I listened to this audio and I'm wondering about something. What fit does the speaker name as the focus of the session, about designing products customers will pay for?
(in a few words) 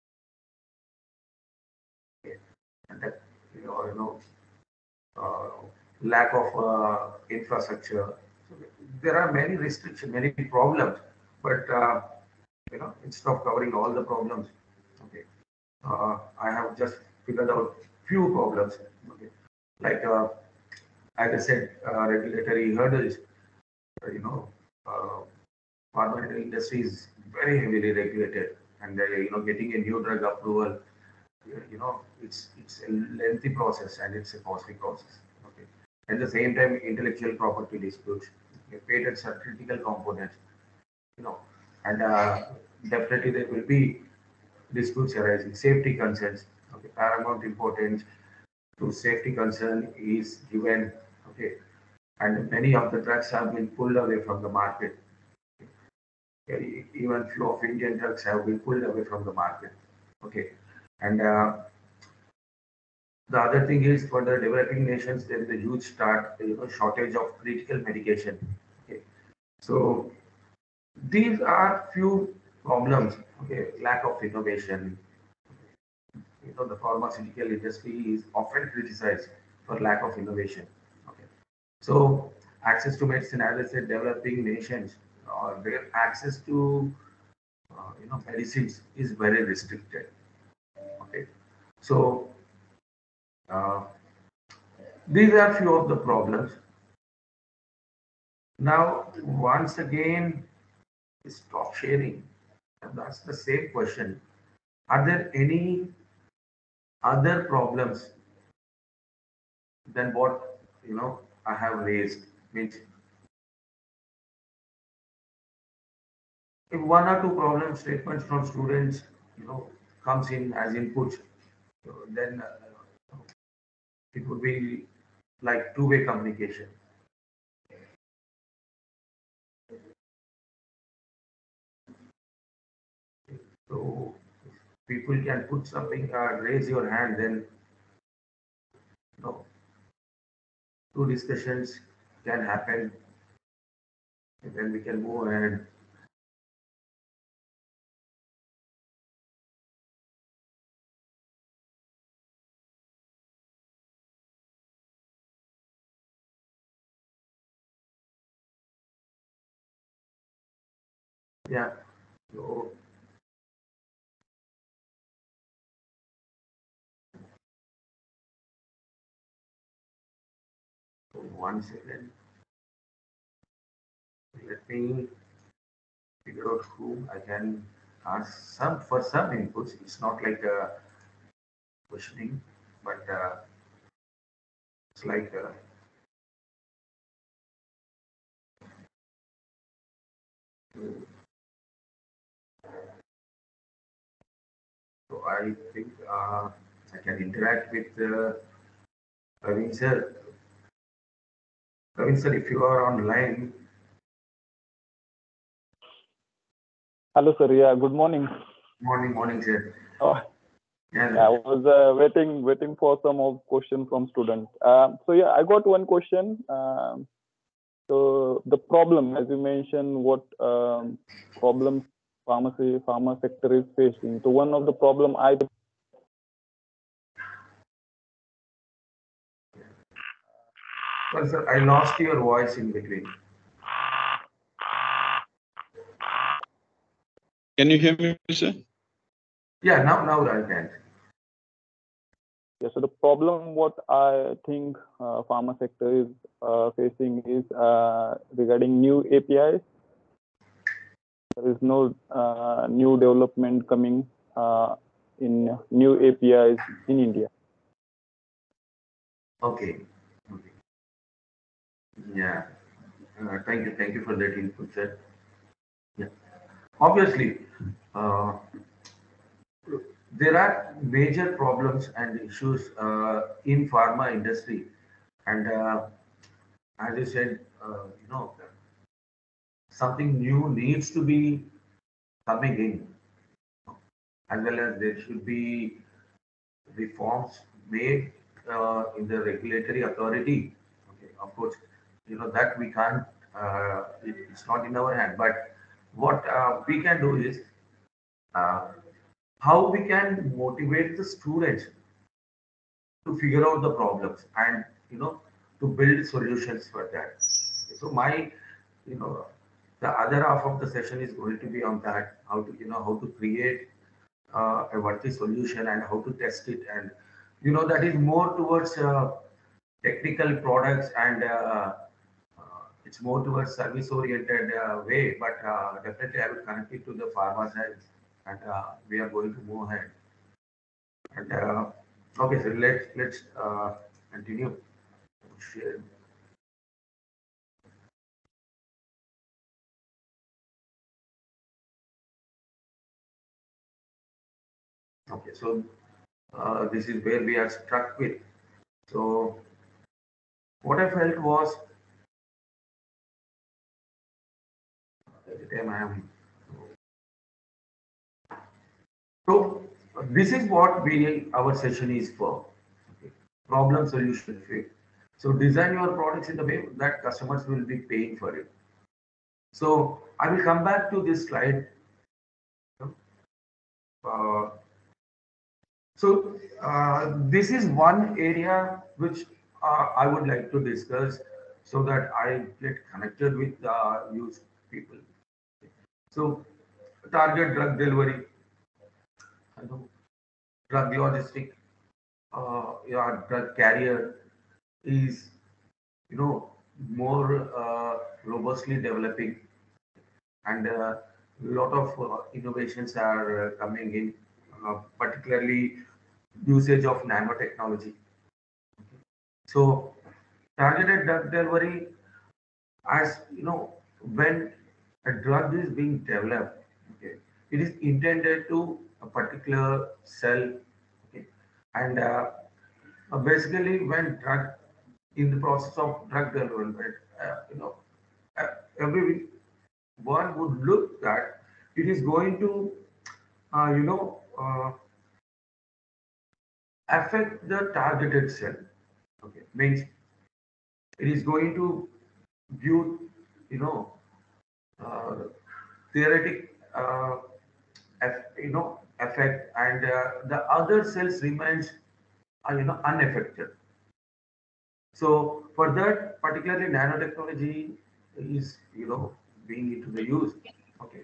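problem solution fit.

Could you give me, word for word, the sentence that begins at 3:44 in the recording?
So one of the problem I Well, sir, I lost your voice in between.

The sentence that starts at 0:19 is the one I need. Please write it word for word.
Okay, like as uh, I said, uh, regulatory hurdles.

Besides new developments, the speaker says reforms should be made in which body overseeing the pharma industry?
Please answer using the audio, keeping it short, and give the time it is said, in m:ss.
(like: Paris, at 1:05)
regulatory authority, at 4:49.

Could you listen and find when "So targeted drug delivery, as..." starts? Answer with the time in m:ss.
6:49.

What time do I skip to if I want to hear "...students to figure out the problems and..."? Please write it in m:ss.
5:01.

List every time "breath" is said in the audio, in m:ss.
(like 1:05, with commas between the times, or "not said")
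not said.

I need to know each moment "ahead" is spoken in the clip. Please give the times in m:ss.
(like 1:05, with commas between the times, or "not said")
2:25, 5:29.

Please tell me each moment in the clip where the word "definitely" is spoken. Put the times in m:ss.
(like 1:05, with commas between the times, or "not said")
0:42, 5:25.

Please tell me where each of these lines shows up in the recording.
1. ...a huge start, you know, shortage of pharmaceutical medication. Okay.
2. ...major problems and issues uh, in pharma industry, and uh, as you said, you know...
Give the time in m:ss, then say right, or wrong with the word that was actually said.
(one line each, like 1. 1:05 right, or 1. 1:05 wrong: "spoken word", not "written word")
1. 1:05 wrong: "critical", not "pharmaceutical"
2. 4:30 right.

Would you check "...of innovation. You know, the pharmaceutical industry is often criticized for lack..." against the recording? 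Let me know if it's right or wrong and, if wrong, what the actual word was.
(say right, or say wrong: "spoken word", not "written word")
right.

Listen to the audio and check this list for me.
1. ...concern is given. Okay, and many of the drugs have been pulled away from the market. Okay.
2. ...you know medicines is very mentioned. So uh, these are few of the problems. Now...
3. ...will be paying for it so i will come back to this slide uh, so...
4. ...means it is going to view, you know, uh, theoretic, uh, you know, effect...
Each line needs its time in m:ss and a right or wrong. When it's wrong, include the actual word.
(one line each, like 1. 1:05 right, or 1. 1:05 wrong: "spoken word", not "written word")
1. 0:49 right
2. 1:28 wrong: "restricted", not "mentioned"
3. 6:07 right
4. 7:19 right.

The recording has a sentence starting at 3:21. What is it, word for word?
Praveen sir, if you are online.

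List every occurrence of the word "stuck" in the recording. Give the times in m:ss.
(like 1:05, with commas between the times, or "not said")
5:47.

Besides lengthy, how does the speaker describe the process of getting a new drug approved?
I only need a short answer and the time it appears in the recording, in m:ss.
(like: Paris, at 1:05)
costly, at 0:34.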